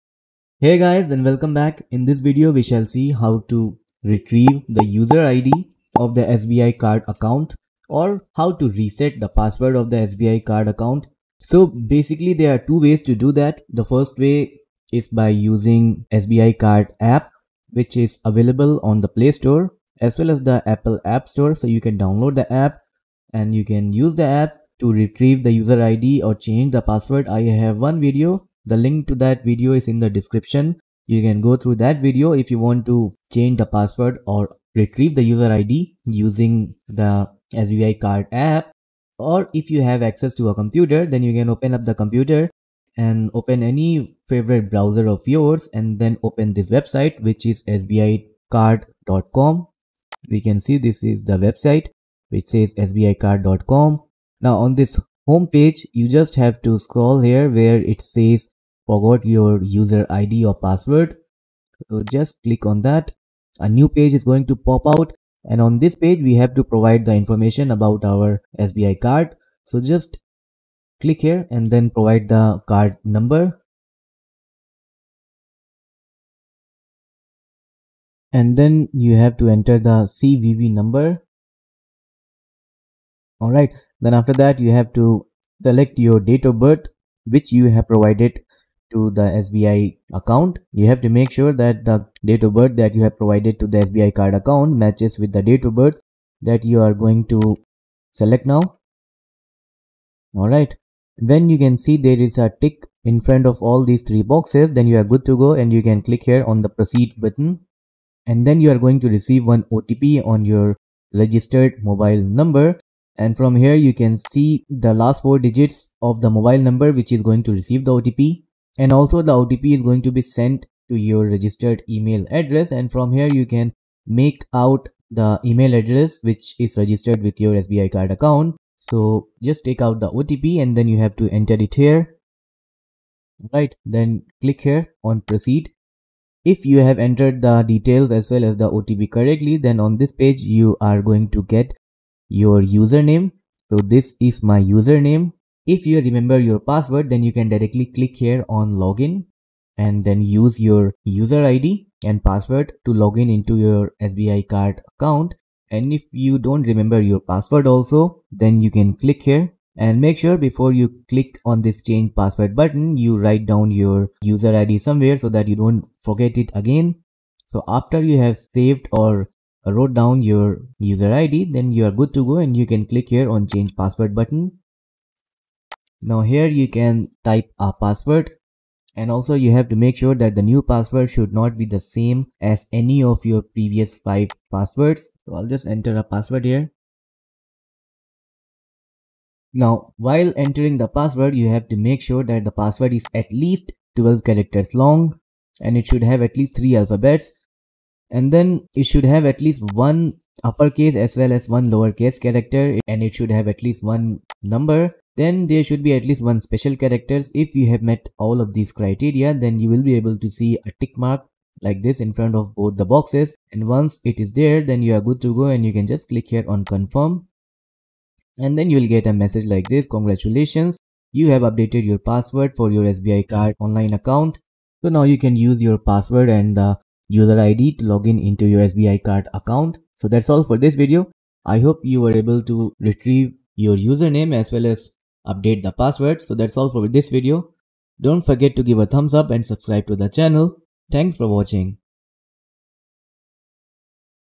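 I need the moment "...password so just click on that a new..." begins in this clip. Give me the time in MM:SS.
01:00.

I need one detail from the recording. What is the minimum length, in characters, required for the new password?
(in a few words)
12.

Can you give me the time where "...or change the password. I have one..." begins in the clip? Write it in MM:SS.
00:26.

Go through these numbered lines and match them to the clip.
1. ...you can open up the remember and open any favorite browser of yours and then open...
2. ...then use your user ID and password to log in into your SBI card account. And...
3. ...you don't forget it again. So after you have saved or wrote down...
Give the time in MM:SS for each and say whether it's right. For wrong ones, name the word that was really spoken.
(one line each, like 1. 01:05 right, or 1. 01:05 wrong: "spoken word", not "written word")
1. 00:41 wrong: "computer", not "remember"
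2. 02:30 right
3. 02:45 right.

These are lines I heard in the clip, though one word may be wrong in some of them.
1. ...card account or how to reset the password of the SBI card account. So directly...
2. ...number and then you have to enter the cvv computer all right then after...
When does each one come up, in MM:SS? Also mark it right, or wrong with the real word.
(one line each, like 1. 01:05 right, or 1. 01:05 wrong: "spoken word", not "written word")
1. 00:06 wrong: "basically", not "directly"
2. 01:13 wrong: "number", not "computer".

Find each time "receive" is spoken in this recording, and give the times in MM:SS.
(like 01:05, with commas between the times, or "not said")
01:49, 01:57.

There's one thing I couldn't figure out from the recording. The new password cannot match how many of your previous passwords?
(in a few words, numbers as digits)
5.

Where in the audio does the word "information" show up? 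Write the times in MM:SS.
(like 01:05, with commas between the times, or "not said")
01:07.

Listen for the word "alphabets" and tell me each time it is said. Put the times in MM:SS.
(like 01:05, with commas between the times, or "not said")
03:16.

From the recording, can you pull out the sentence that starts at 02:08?
So just take out the OTP and then you have to enter it here.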